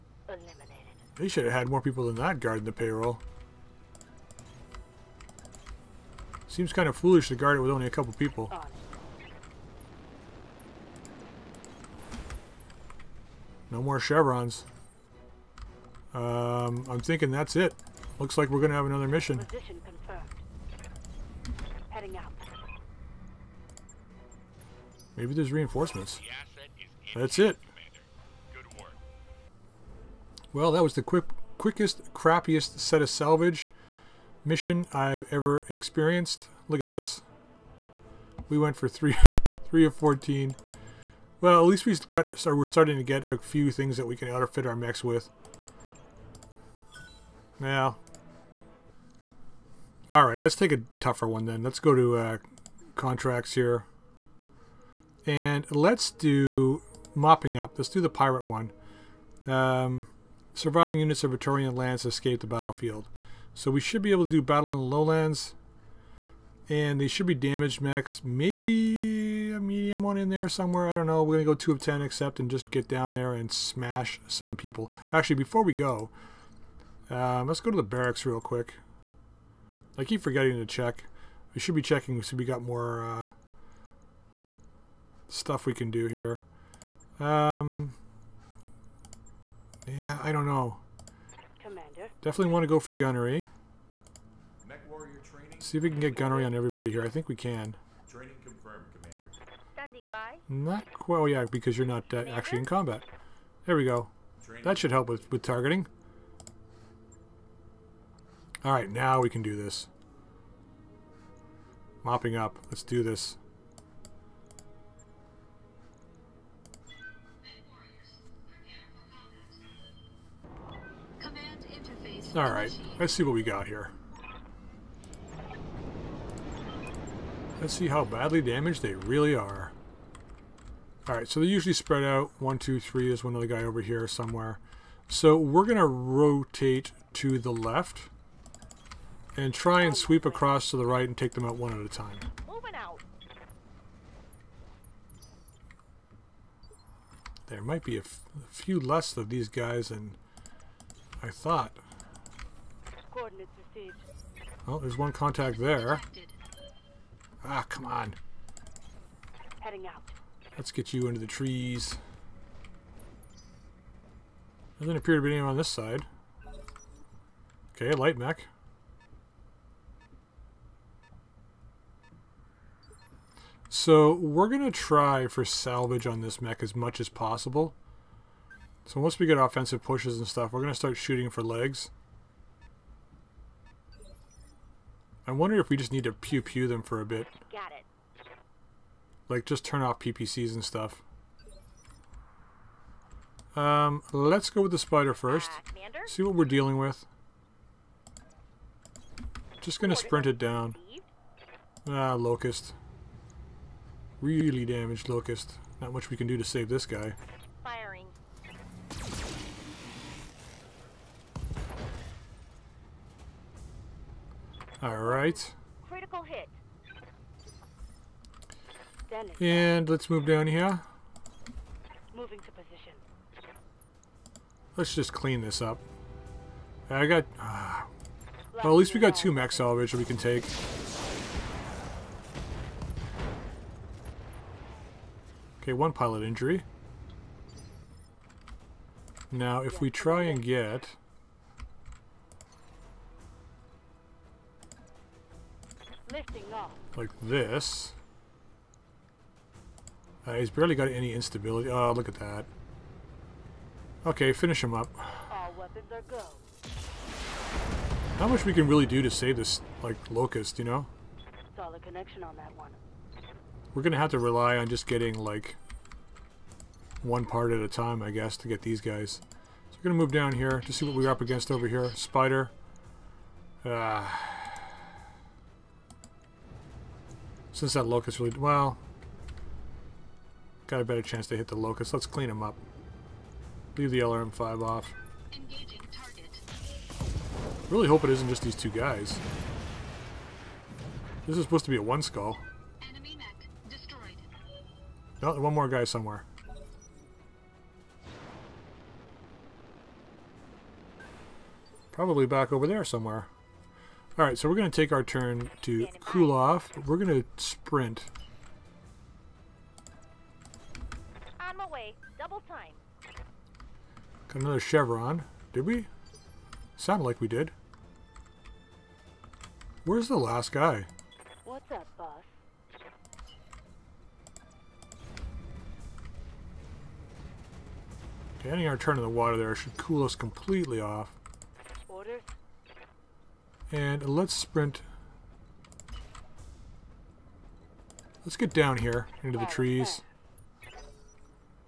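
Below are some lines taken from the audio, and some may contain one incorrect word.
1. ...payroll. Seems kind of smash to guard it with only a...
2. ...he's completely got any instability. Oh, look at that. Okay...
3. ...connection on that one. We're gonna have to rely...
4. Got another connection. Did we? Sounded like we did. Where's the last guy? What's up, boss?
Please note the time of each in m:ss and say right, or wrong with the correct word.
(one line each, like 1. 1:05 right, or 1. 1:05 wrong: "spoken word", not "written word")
1. 0:02 wrong: "foolish", not "smash"
2. 4:10 wrong: "barely", not "completely"
3. 4:21 right
4. 5:14 wrong: "chevron", not "connection".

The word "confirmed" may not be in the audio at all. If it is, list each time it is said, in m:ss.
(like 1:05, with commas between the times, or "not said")
0:19, 1:38.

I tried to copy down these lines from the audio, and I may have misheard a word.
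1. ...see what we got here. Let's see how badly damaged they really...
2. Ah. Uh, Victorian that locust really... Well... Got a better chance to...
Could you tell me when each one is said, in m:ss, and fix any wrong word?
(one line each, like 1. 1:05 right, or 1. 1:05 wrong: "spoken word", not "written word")
1. 2:03 right
2. 4:33 wrong: "Since", not "Victorian".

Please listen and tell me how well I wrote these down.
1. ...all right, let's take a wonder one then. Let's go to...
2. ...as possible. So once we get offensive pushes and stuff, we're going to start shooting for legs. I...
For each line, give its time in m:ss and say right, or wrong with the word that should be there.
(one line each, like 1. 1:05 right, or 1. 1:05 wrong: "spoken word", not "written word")
1. 0:50 wrong: "tougher", not "wonder"
2. 2:56 right.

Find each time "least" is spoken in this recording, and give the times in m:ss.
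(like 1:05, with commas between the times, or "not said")
0:41, 3:48.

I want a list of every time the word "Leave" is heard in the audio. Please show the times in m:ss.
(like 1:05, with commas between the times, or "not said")
4:43.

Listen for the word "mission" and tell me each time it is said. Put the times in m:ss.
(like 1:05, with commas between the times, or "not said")
0:19, 0:34.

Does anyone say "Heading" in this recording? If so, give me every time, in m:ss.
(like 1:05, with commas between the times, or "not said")
0:21, 2:39.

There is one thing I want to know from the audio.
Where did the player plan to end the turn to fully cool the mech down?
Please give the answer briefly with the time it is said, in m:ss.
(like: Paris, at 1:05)
In the water, at 5:28.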